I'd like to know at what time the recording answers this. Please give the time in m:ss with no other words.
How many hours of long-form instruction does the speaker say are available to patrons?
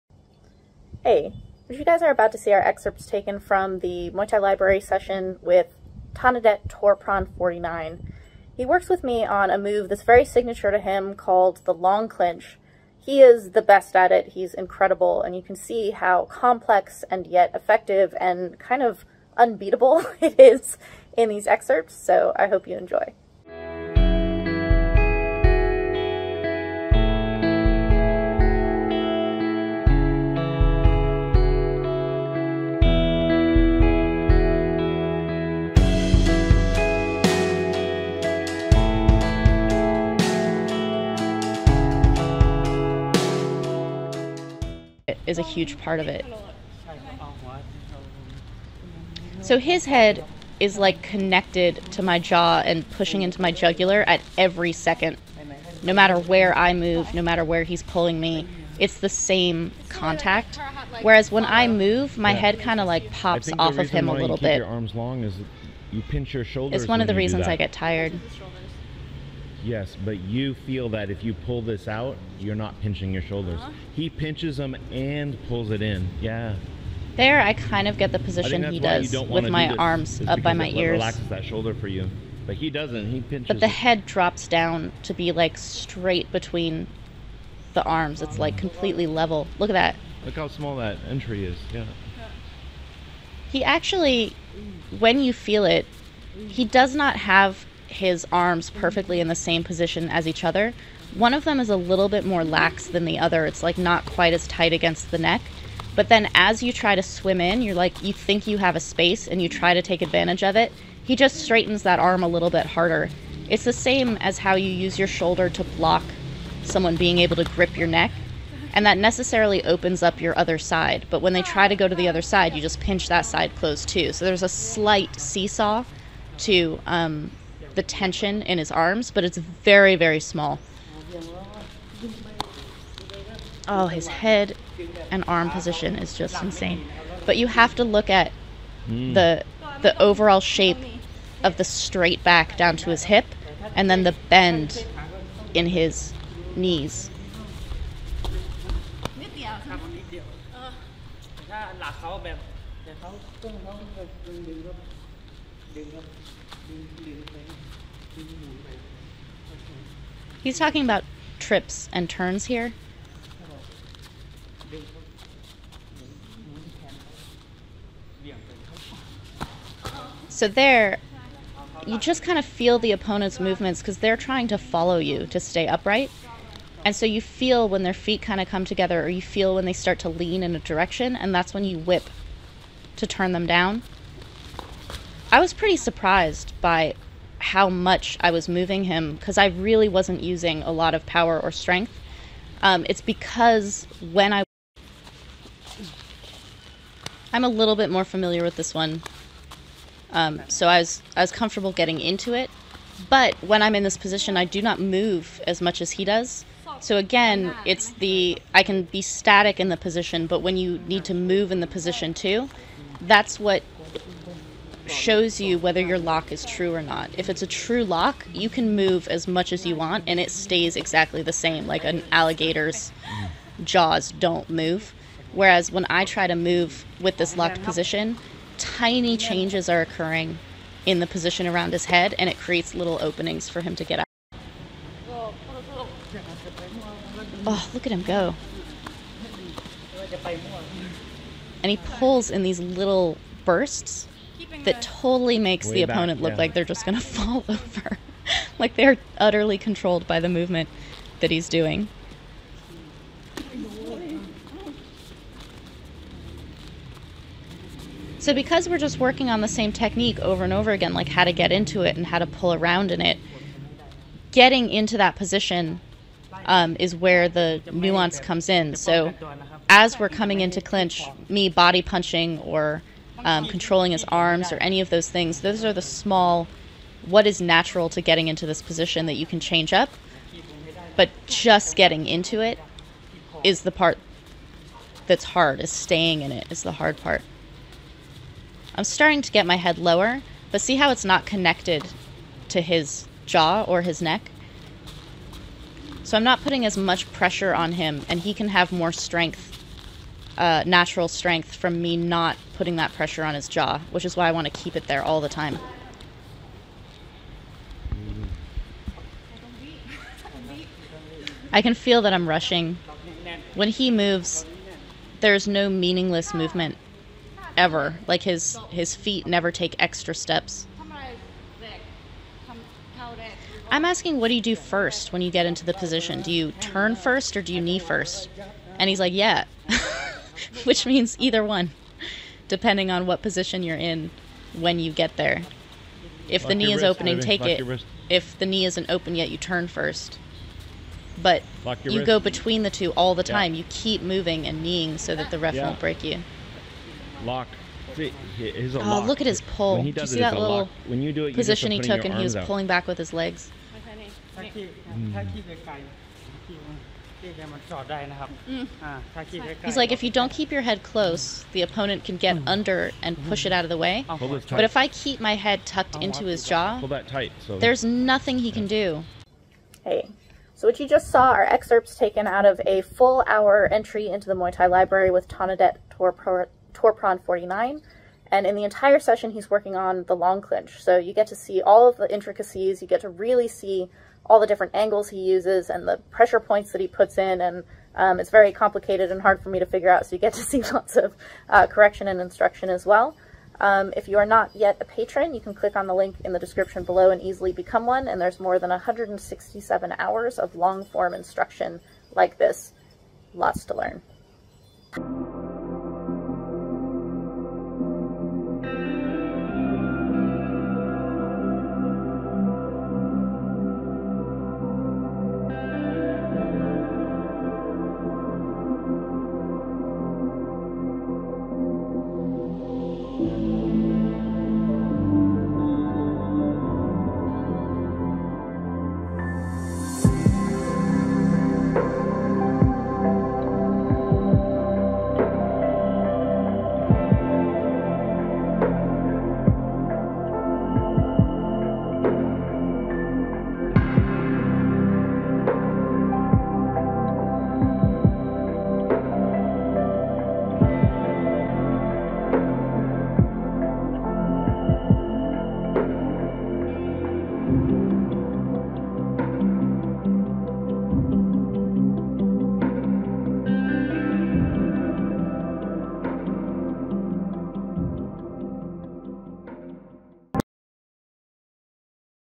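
6:38.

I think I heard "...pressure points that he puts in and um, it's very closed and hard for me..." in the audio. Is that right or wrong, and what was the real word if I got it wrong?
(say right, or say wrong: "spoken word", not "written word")
wrong: "complicated", not "closed".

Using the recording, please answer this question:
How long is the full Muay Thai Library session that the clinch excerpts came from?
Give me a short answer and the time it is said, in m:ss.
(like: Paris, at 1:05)
1 hour, at 6:12.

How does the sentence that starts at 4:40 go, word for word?
But just getting into it is the part that's hard, is staying in it is the hard part.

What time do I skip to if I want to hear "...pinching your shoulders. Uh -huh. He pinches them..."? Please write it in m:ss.
1:12.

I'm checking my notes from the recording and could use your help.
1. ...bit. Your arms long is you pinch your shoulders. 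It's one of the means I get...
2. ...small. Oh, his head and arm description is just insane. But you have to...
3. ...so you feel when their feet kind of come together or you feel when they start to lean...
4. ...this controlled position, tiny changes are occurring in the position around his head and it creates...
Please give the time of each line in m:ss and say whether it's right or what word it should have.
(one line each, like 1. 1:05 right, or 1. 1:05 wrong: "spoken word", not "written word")
1. 1:04 wrong: "reasons", not "means"
2. 2:10 wrong: "position", not "description"
3. 2:56 right
4. 3:47 wrong: "locked", not "controlled".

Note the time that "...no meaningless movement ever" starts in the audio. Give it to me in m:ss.
5:15.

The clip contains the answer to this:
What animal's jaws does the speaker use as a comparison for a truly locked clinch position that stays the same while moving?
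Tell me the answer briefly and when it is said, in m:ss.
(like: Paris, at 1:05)
alligator, at 3:42.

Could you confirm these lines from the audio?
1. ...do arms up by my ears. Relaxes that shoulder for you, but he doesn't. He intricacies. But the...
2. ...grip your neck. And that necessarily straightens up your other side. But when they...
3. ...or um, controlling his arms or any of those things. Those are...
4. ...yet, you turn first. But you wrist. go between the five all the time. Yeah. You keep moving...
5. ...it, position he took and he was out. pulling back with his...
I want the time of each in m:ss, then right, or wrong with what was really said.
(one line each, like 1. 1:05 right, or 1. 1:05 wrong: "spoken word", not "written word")
1. 1:19 wrong: "pinches", not "intricacies"
2. 1:57 wrong: "opens", not "straightens"
3. 4:32 right
4. 5:39 wrong: "two", not "five"
5. 5:51 right.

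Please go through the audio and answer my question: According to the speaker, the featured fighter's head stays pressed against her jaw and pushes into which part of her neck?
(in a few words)
jugular.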